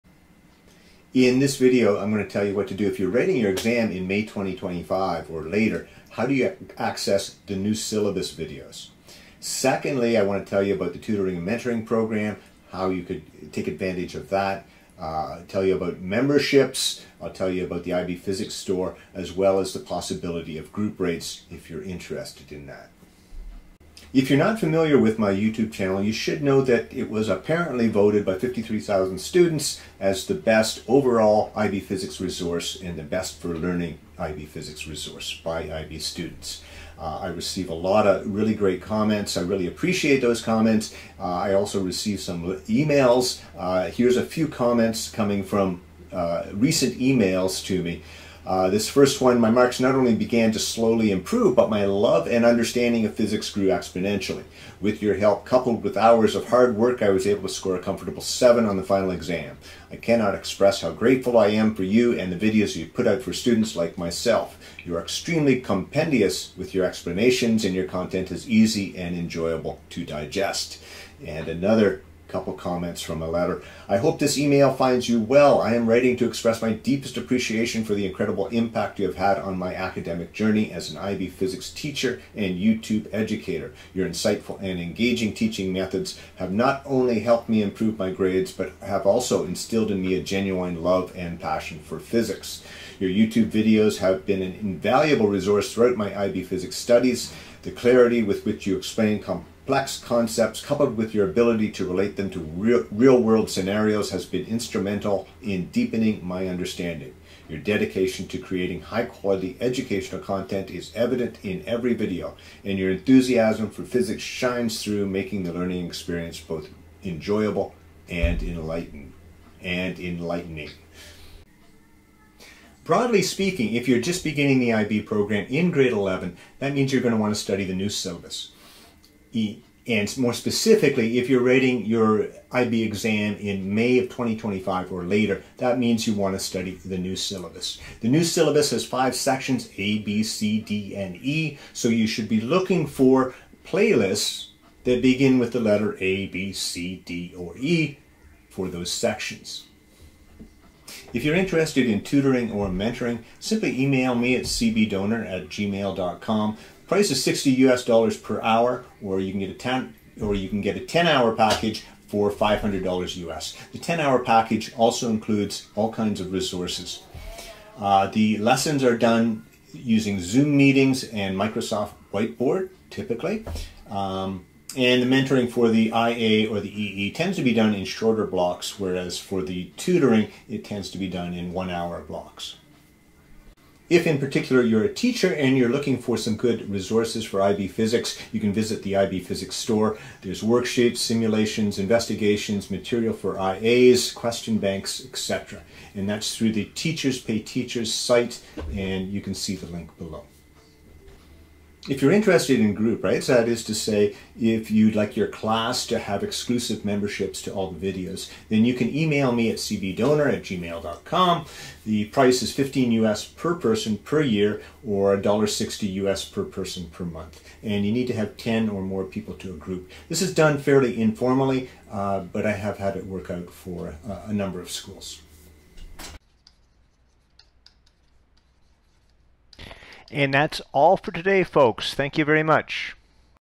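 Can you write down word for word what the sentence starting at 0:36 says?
Uh, I receive a lot of really great comments.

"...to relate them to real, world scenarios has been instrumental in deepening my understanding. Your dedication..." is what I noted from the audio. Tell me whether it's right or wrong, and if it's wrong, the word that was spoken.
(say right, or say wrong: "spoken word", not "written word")
right.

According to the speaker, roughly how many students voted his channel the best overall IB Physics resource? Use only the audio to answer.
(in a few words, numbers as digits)
53,000.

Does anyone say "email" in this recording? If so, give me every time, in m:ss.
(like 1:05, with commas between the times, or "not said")
0:42, 0:46, 1:14, 2:33, 3:28.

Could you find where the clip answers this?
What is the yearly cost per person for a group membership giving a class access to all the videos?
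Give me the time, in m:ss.
3:32.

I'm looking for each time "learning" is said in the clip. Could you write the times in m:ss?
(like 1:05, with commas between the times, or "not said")
0:33, 1:55.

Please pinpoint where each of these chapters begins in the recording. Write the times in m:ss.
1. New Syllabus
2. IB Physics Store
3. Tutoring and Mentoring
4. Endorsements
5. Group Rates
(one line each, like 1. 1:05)
1. 2:02
2. 3:03
3. 2:31
4. 0:24
5. 3:21.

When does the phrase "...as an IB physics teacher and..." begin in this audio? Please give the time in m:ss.
1:20.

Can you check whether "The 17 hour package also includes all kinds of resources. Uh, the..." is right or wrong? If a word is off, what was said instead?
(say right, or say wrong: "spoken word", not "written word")
wrong: "10", not "17".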